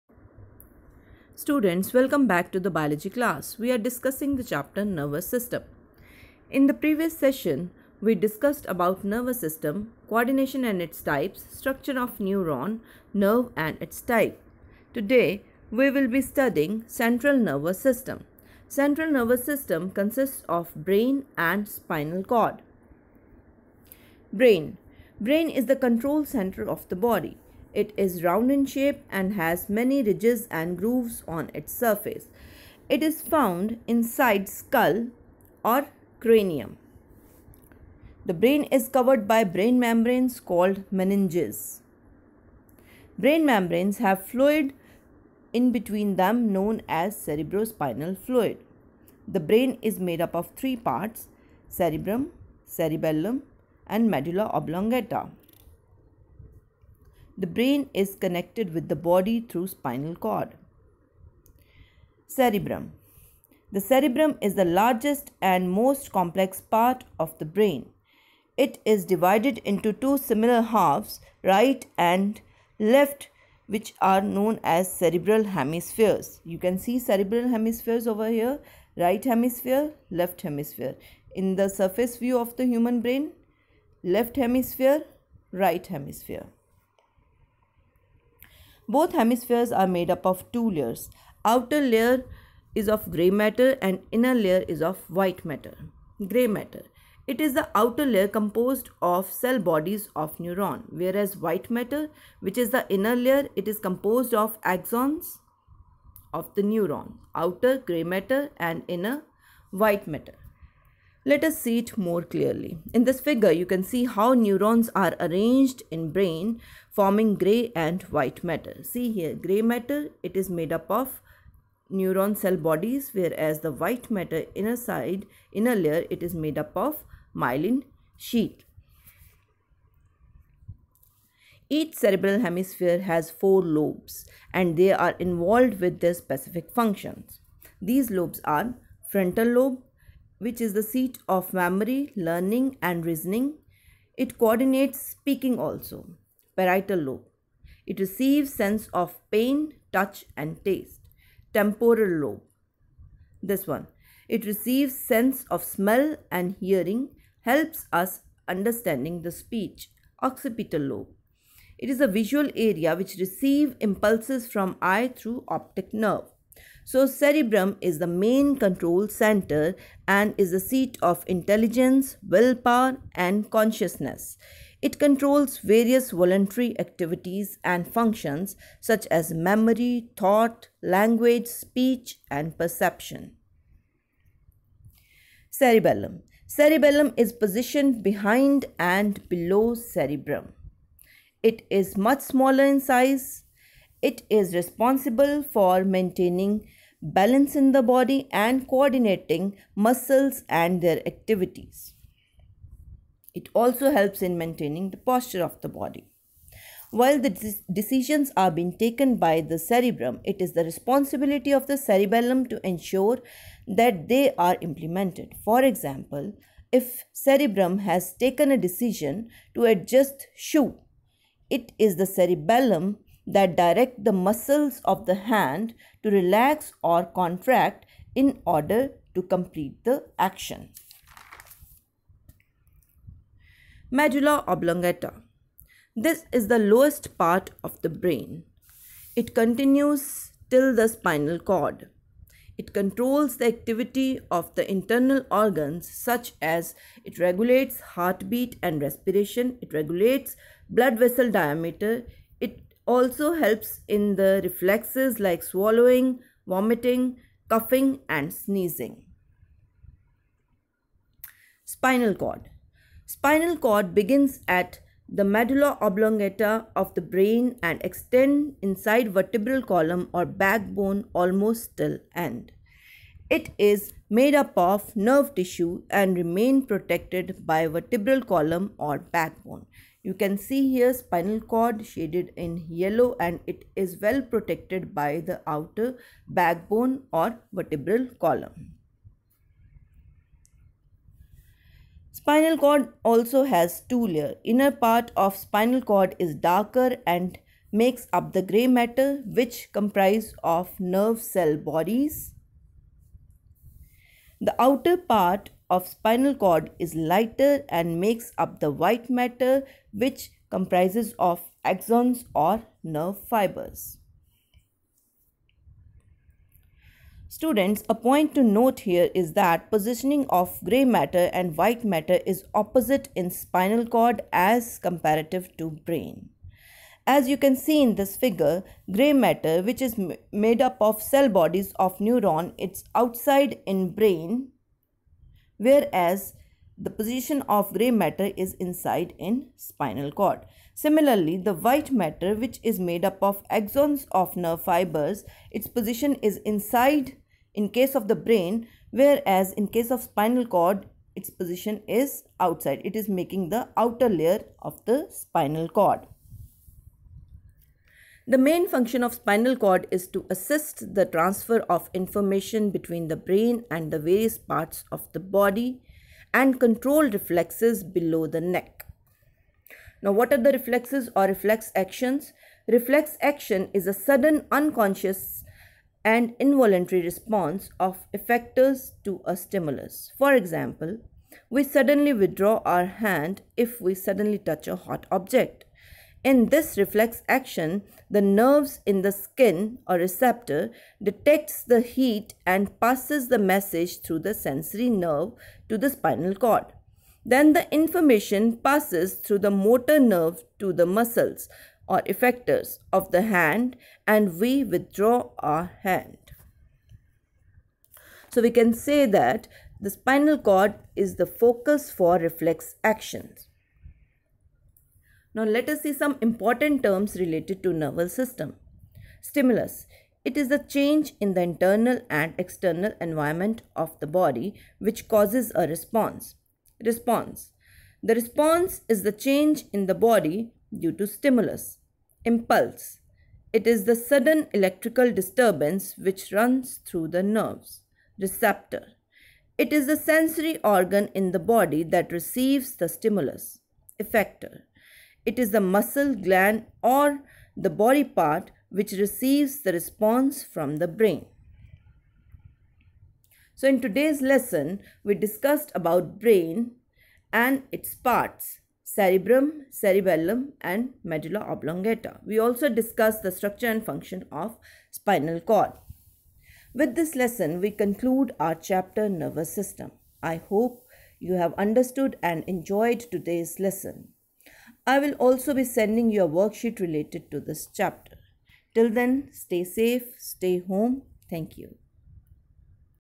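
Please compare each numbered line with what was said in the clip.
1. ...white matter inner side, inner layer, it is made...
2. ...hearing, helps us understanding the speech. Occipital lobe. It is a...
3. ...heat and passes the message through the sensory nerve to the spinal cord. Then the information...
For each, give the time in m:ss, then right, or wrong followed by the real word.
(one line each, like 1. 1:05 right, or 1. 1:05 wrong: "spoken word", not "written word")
1. 2:03 right
2. 2:36 right
3. 6:31 right.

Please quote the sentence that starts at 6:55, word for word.
Now let us see some important terms related to nervous system.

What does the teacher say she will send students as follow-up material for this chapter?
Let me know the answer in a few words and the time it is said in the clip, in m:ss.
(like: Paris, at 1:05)
a worksheet, at 7:56.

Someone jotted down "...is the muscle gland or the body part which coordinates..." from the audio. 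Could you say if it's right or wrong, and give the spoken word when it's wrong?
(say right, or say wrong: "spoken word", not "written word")
wrong: "receives", not "coordinates".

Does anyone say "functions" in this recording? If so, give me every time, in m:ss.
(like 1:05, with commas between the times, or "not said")
2:16, 2:57, 5:58, 7:43.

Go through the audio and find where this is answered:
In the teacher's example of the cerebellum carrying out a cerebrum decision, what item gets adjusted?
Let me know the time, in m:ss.
3:40.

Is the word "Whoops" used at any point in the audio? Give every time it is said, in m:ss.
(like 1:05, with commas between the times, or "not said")
not said.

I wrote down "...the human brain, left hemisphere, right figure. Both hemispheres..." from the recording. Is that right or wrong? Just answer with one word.
wrong.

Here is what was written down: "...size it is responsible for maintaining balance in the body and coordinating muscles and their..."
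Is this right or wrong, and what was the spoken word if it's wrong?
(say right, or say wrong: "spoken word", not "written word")
right.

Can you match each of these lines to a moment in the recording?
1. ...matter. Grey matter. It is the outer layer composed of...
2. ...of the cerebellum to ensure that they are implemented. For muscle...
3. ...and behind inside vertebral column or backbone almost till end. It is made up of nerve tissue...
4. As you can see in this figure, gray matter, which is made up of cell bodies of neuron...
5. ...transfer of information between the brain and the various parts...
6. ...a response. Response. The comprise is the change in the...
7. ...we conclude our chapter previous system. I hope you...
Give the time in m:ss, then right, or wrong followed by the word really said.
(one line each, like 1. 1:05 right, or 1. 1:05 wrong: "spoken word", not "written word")
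1. 1:35 right
2. 3:31 wrong: "example", not "muscle"
3. 4:27 wrong: "extend", not "behind"
4. 5:27 right
5. 6:01 right
6. 7:05 wrong: "response", not "comprise"
7. 7:47 wrong: "nervous", not "previous".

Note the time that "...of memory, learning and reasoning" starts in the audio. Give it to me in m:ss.
2:21.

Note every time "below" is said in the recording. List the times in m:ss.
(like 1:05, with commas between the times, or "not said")
3:09, 6:07.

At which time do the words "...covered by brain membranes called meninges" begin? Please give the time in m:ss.
0:38.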